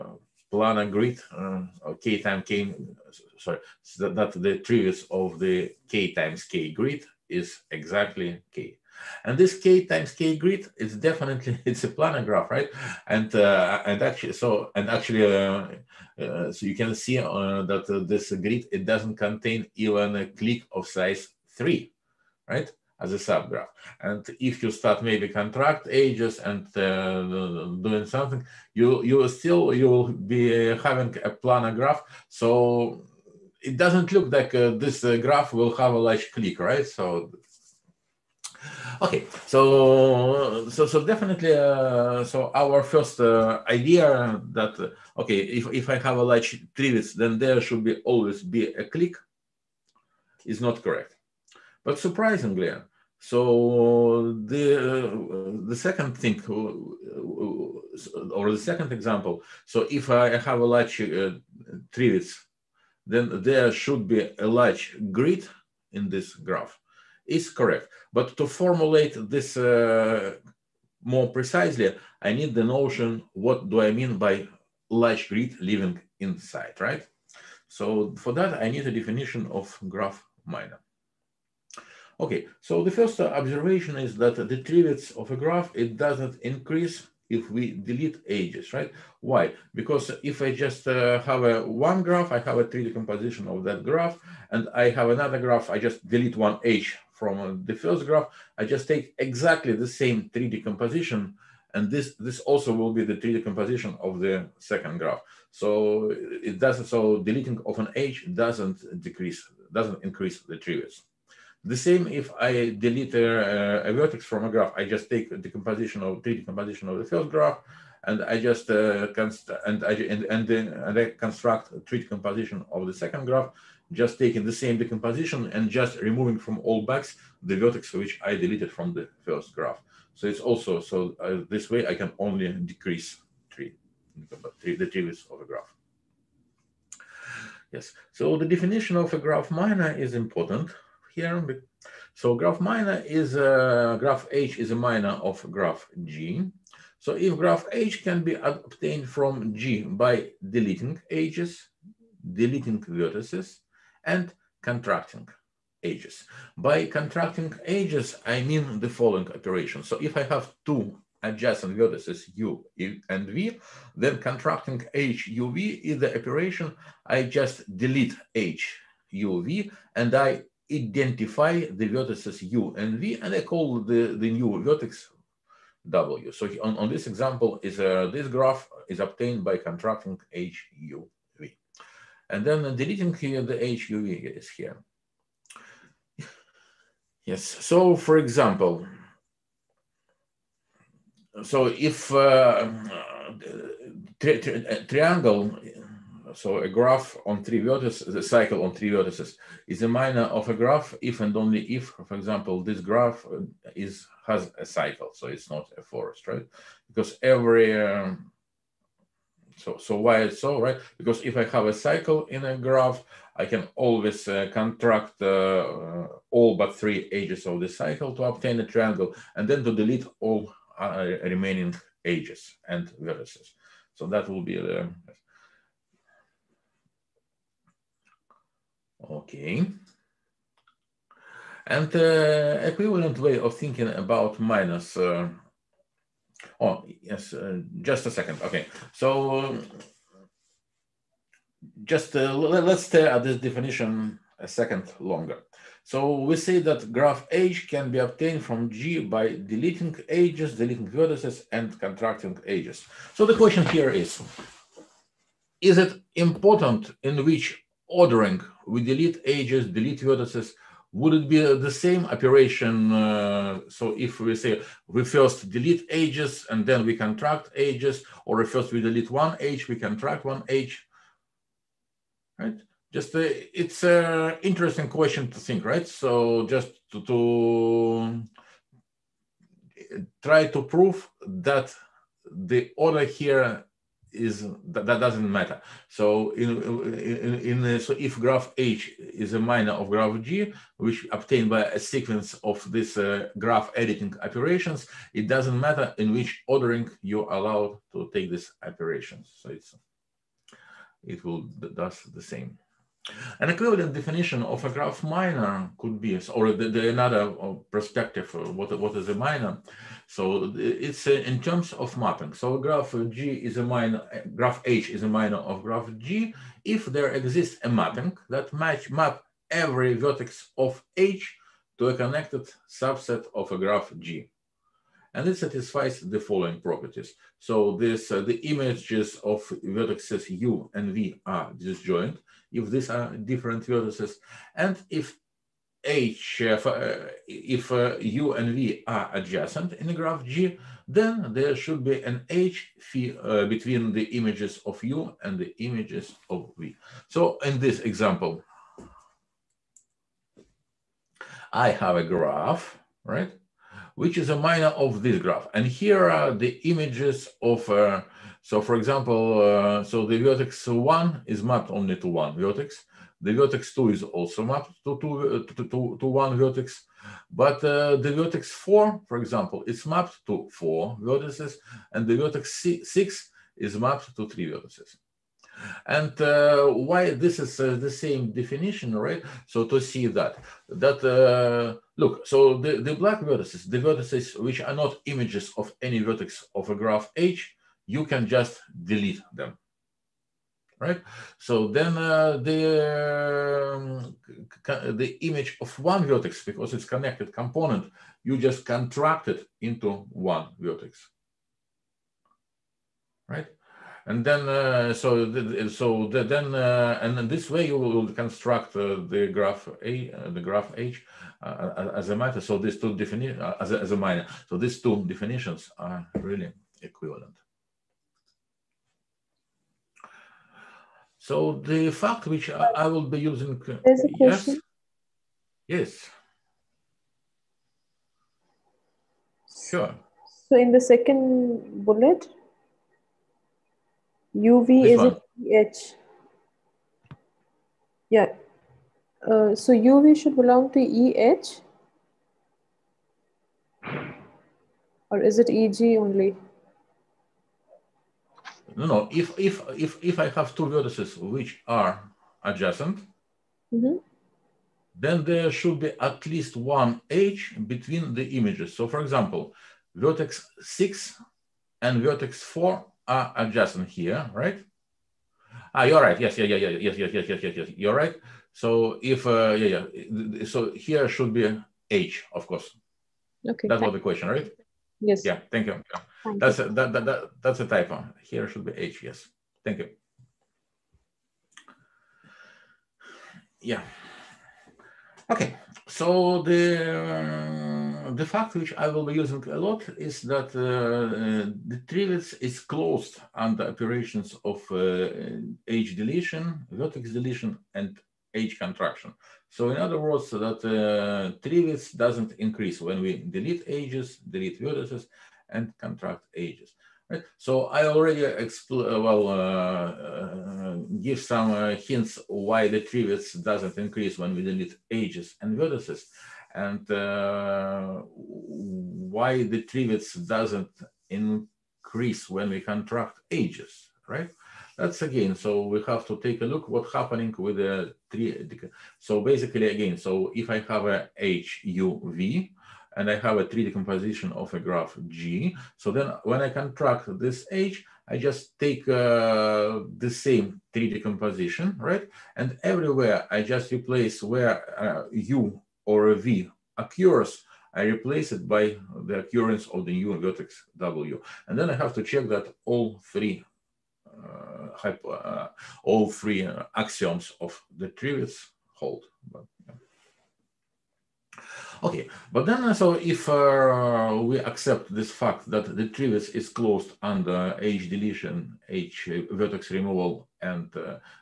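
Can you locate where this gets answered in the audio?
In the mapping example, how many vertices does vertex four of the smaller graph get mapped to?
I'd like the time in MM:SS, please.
06:10.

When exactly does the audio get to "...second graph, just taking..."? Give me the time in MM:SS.
02:03.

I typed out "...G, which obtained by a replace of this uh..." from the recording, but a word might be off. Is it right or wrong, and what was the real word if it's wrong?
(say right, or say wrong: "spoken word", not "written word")
wrong: "sequence", not "replace".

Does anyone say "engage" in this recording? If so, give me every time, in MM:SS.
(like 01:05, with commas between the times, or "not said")
not said.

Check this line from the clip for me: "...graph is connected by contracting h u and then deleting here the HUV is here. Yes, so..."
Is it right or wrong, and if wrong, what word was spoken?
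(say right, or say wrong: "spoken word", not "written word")
wrong: "obtained", not "connected".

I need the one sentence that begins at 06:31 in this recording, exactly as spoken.
So then uh, the, um, the image of one vertex, because it's connected component, you just contract it into one vertex, right?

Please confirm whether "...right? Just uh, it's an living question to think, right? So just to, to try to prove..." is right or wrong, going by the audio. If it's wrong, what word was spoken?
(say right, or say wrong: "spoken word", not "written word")
wrong: "interesting", not "living".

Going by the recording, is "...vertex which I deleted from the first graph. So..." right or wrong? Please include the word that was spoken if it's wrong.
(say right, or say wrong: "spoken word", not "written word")
right.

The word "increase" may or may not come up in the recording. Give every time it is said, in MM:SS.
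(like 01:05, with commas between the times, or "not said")
01:26, 01:50, 08:22, 08:33, 08:41.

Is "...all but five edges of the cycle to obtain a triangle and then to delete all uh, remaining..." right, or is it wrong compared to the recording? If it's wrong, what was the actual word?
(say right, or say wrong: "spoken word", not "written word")
wrong: "three", not "five".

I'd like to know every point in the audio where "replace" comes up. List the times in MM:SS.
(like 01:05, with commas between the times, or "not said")
09:03, 09:07.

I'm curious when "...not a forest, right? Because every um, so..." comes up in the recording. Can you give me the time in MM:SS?
03:25.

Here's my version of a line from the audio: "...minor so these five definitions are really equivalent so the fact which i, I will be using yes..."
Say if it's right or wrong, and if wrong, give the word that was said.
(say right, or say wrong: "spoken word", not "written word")
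wrong: "two", not "five".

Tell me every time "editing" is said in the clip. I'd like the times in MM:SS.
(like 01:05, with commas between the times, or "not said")
04:53.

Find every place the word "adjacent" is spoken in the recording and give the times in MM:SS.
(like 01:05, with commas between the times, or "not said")
02:41, 05:39, 07:32.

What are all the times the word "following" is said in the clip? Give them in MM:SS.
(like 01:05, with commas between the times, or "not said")
02:38, 05:26.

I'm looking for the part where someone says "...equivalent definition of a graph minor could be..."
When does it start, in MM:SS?
05:03.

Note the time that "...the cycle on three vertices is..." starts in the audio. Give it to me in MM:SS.
03:18.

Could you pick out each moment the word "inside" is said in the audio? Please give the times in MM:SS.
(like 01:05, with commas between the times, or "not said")
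01:16.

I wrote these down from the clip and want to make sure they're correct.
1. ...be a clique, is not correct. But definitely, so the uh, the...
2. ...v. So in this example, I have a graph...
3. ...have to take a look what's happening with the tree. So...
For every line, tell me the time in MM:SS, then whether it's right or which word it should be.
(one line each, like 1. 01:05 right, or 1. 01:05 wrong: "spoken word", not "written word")
1. 00:48 wrong: "surprisingly", not "definitely"
2. 05:46 right
3. 08:45 right.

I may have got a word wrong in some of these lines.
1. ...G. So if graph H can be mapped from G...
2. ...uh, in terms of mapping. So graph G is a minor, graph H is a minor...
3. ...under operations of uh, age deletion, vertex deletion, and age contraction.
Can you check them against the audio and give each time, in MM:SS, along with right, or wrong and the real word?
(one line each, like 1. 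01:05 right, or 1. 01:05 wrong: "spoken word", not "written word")
1. 02:26 wrong: "obtained", not "mapped"
2. 05:11 right
3. 08:13 right.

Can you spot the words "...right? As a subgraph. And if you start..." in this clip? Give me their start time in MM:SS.
00:22.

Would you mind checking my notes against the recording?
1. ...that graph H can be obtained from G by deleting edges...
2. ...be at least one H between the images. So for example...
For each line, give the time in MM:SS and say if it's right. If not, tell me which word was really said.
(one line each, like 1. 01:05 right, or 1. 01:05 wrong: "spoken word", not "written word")
1. 04:06 right
2. 07:35 right.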